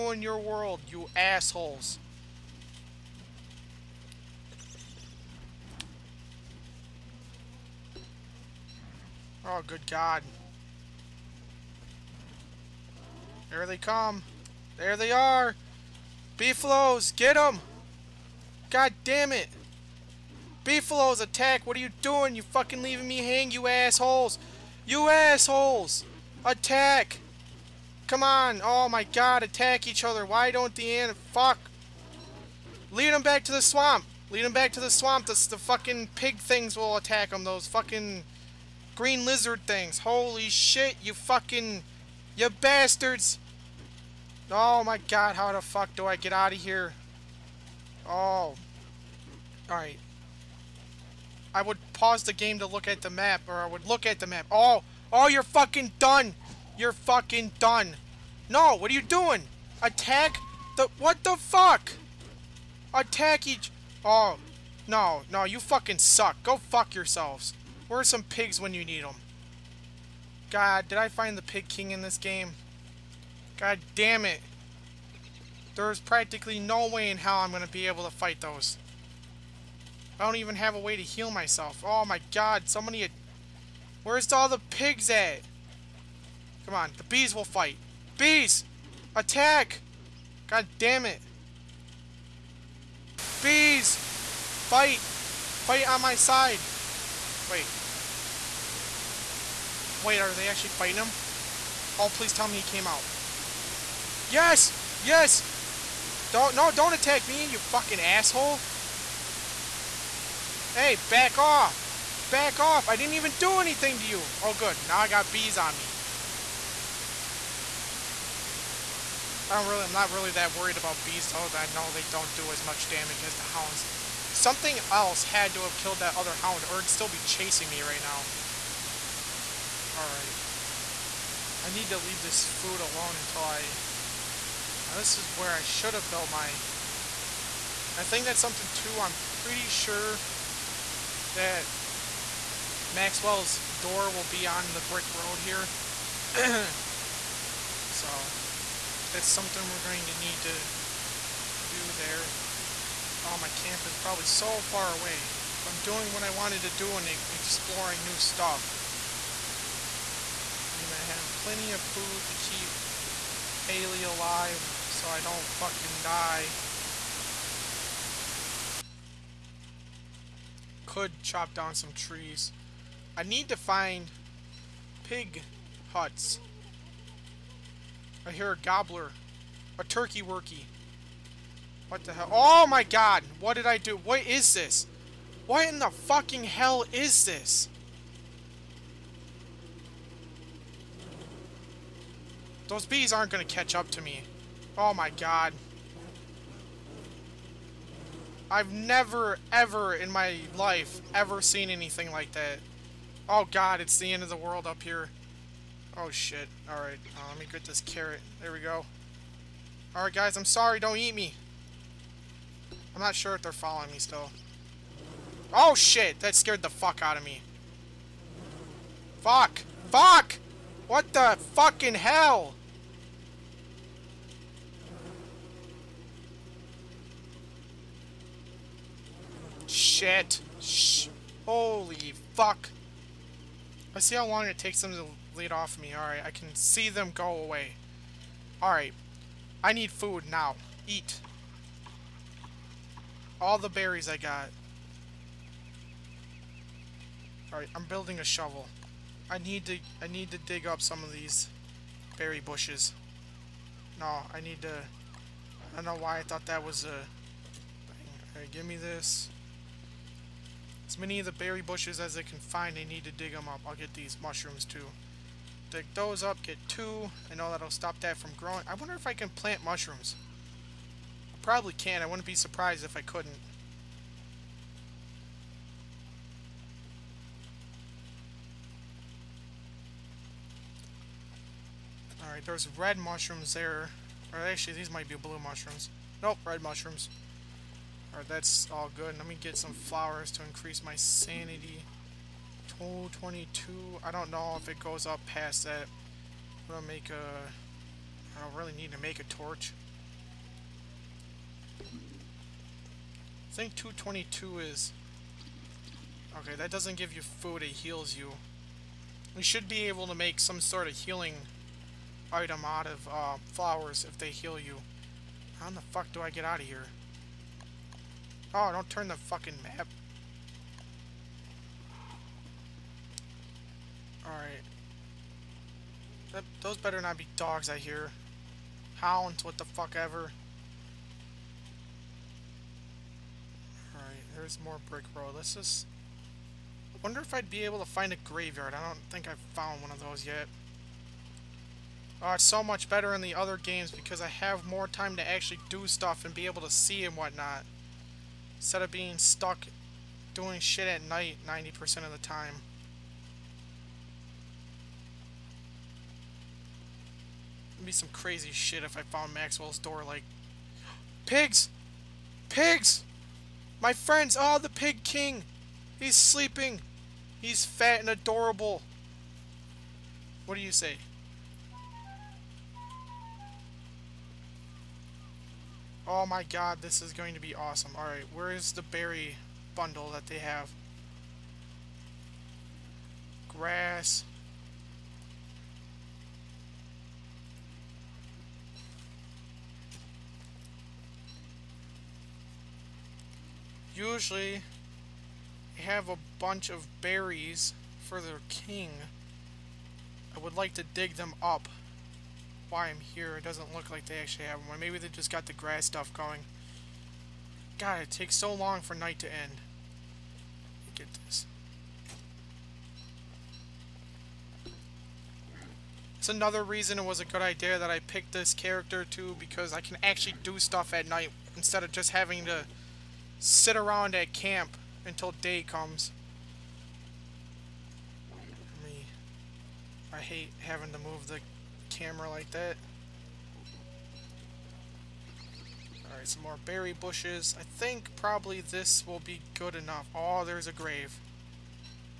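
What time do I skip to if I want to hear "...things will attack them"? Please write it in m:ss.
0:36.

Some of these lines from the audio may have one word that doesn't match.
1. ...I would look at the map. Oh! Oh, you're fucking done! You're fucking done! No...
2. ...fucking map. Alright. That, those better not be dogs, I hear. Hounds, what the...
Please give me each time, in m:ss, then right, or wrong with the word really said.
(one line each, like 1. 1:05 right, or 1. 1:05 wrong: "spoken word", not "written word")
1. 0:53 right
2. 5:19 right.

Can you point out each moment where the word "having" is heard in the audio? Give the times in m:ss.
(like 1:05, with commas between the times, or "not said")
7:02, 7:10.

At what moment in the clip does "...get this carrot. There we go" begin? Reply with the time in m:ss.
3:27.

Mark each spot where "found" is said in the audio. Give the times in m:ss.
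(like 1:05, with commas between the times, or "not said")
5:39, 5:59.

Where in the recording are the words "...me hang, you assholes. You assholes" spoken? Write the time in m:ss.
0:23.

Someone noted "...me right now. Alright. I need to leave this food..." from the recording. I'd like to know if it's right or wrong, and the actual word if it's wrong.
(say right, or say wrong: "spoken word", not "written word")
right.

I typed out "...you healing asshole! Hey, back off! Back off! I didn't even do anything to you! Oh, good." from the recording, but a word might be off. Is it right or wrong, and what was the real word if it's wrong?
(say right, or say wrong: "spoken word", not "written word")
wrong: "fucking", not "healing".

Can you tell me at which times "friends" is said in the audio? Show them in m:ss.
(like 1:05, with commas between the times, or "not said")
6:03.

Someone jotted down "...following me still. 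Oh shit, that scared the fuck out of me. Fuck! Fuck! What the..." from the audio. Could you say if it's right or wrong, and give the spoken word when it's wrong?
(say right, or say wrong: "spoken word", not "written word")
right.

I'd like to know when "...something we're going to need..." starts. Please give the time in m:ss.
2:29.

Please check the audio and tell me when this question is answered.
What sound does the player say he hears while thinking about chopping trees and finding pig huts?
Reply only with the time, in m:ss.
2:58.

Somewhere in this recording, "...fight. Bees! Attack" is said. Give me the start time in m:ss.
1:27.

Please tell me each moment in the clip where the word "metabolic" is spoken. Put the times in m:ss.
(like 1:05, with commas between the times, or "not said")
not said.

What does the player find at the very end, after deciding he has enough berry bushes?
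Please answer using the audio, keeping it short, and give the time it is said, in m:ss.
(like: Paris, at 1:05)
A grave, at 7:20.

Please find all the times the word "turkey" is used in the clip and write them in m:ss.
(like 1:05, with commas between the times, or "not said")
2:59.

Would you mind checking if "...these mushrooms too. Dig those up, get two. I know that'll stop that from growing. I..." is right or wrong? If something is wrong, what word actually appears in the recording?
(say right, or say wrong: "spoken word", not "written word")
right.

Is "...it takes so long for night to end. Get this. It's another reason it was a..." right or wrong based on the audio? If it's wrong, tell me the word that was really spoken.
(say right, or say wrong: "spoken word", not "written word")
right.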